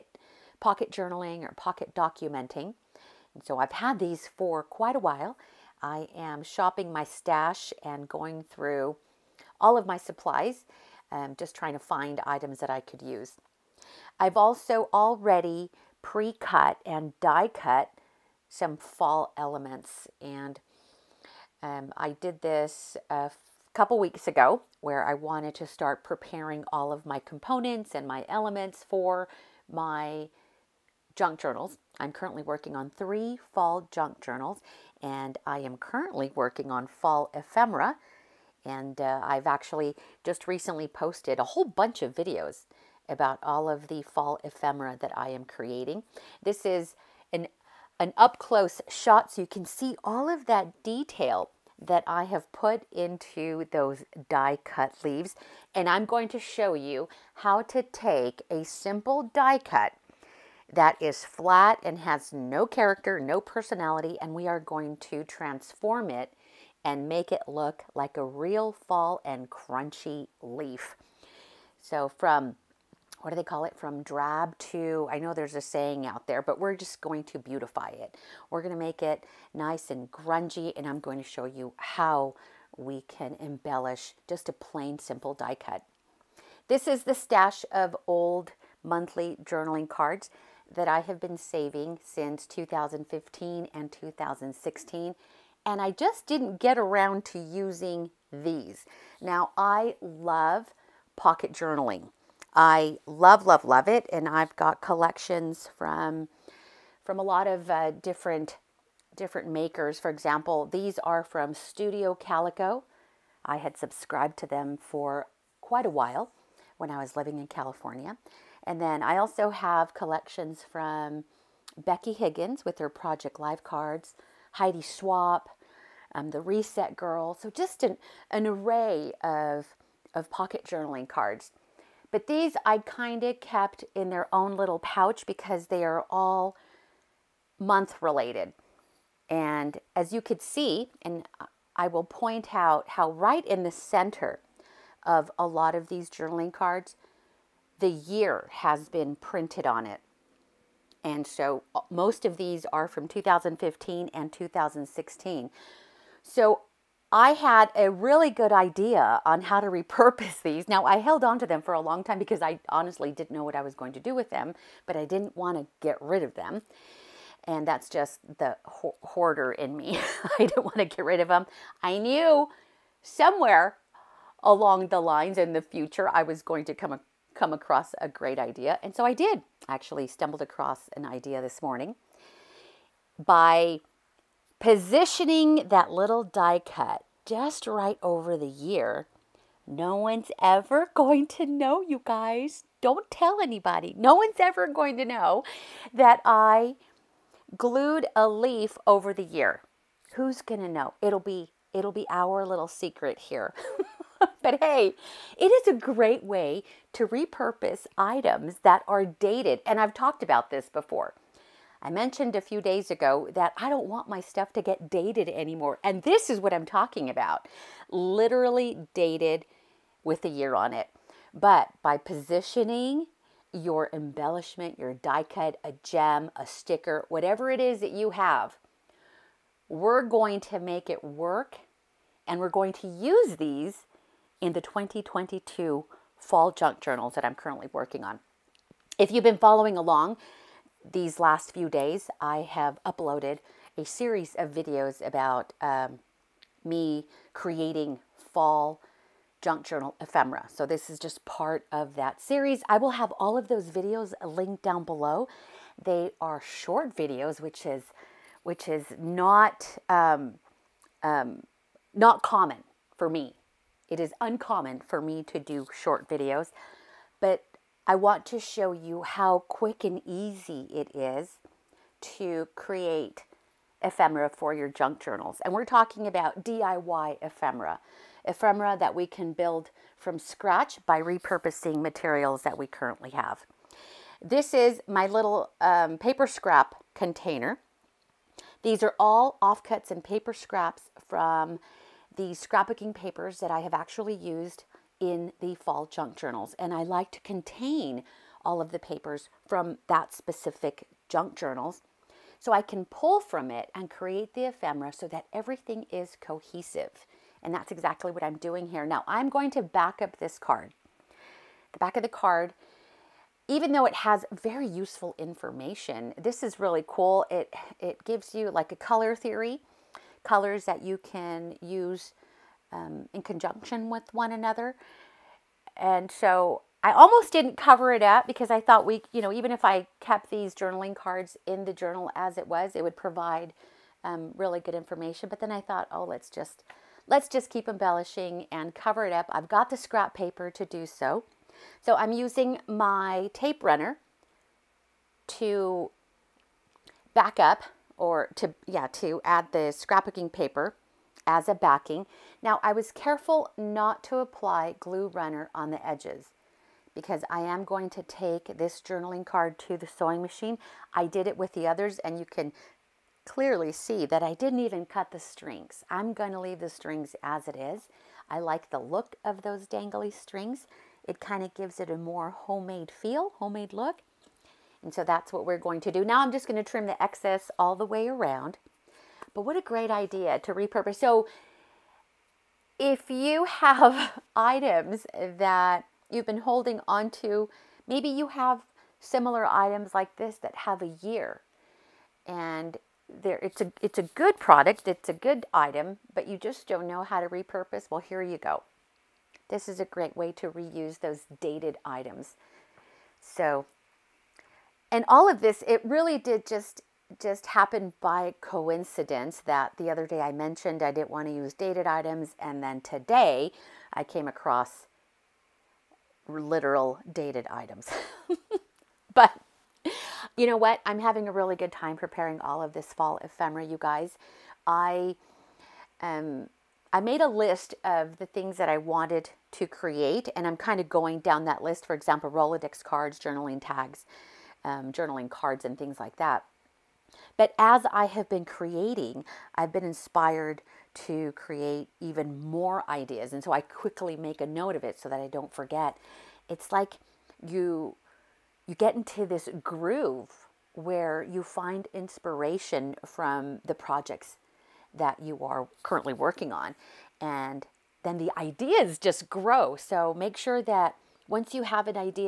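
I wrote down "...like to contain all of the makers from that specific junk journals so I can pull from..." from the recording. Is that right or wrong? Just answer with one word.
wrong.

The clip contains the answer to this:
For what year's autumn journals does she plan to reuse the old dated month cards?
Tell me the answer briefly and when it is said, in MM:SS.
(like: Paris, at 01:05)
2022, at 03:54.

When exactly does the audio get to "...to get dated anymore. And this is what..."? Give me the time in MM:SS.
03:34.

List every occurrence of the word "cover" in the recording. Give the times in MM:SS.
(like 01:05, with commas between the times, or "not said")
05:27, 05:38.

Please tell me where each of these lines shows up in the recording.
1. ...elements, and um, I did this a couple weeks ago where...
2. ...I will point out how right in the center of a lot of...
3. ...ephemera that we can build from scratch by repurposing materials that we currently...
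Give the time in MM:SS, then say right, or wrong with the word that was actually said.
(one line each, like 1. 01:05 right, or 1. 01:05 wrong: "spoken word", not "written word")
1. 00:19 right
2. 02:21 right
3. 04:38 right.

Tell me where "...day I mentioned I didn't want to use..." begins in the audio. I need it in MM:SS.
06:50.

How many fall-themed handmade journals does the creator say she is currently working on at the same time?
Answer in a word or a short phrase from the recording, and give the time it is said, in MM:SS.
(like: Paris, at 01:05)
3, at 00:32.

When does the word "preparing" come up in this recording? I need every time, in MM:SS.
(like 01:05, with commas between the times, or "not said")
00:26, 07:01.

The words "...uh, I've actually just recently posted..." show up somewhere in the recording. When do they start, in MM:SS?
00:38.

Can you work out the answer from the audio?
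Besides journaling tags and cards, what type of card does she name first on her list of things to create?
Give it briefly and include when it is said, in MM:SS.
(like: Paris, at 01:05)
Rolodex cards, at 07:12.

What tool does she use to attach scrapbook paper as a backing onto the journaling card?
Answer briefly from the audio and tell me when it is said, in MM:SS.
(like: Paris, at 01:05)
tape runner, at 05:43.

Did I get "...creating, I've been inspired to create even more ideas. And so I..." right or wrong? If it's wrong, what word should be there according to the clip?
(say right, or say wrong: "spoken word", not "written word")
right.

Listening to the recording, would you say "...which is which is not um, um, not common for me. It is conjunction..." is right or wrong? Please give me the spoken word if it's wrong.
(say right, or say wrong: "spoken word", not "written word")
wrong: "uncommon", not "conjunction".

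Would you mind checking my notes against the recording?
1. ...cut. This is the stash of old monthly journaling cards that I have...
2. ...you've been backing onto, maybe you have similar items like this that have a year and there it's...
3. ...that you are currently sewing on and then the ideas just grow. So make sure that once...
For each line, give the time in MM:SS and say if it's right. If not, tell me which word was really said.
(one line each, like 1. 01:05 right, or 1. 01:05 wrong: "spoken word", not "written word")
1. 01:25 right
2. 06:26 wrong: "holding", not "backing"
3. 07:34 wrong: "working", not "sewing".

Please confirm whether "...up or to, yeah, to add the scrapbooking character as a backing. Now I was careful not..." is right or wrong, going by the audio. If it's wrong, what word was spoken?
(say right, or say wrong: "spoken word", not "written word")
wrong: "paper", not "character".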